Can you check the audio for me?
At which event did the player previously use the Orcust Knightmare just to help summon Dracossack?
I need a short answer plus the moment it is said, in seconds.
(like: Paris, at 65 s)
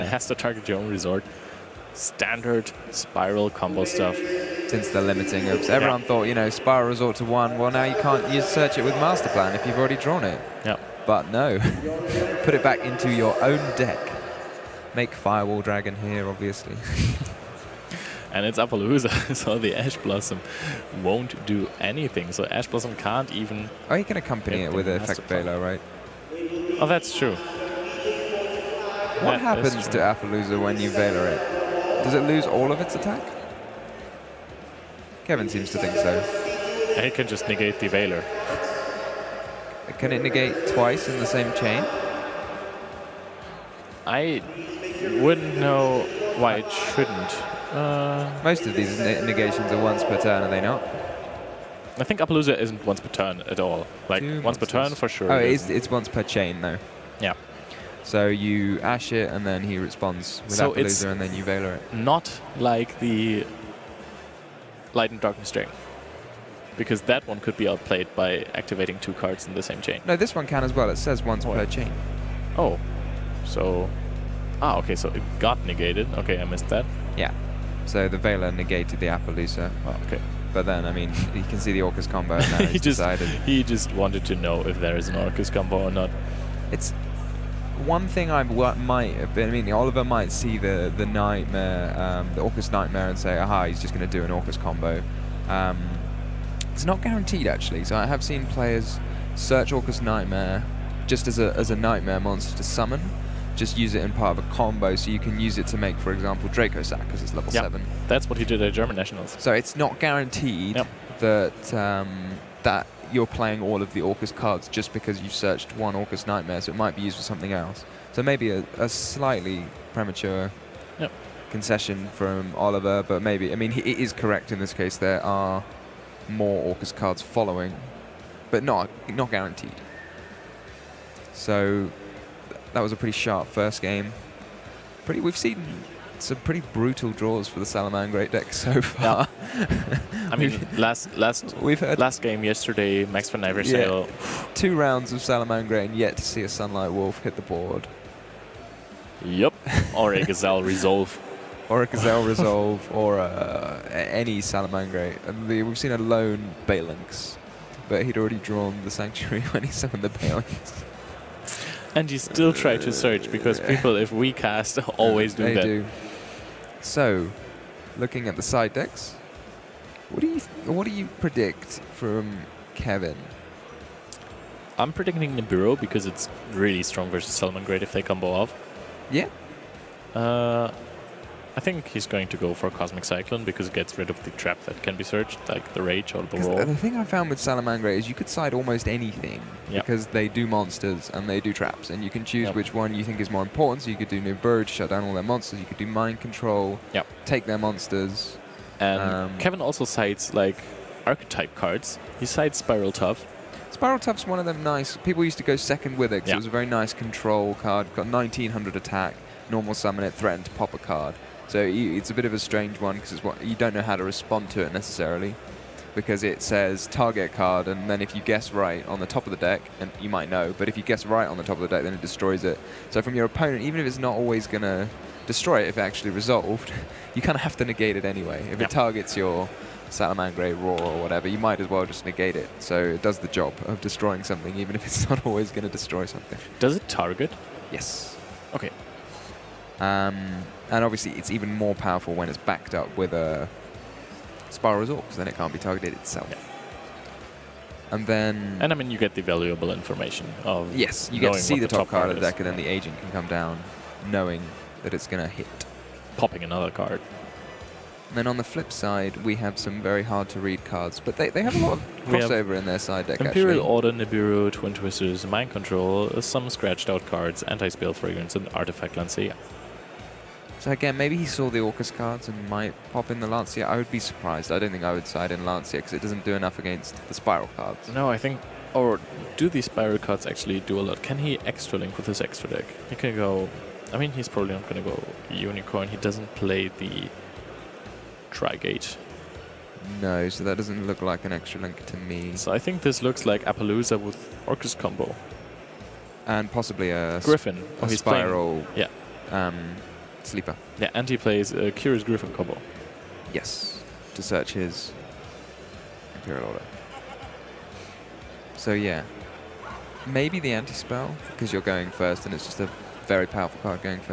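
German Nationals, at 108 s.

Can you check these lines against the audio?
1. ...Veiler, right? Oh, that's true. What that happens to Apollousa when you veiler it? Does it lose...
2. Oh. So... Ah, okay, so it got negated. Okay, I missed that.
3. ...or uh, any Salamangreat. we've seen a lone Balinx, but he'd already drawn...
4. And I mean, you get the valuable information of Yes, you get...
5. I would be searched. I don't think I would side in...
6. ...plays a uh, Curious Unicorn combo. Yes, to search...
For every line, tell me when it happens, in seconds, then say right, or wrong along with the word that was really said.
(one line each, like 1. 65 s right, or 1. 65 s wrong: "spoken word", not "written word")
1. 25 s right
2. 72 s right
3. 152 s right
4. 248 s right
5. 273 s wrong: "surprised", not "searched"
6. 301 s wrong: "Griffin", not "Unicorn".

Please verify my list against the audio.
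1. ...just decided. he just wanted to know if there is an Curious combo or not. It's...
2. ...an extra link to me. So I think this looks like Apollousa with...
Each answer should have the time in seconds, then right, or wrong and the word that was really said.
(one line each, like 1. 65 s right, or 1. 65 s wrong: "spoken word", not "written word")
1. 82 s wrong: "Orcust", not "Curious"
2. 291 s right.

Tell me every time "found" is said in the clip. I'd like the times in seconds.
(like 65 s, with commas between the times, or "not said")
187 s.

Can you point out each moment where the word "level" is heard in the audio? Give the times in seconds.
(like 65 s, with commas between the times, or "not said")
107 s.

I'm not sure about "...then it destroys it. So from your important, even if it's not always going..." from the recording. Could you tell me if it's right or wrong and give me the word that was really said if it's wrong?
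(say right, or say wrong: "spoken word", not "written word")
wrong: "opponent", not "important".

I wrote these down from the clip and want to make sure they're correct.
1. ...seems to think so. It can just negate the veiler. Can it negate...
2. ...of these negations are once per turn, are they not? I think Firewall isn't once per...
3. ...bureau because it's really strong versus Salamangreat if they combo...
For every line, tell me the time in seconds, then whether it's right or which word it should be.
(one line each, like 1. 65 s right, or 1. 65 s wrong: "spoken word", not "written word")
1. 35 s right
2. 48 s wrong: "Apollousa", not "Firewall"
3. 175 s right.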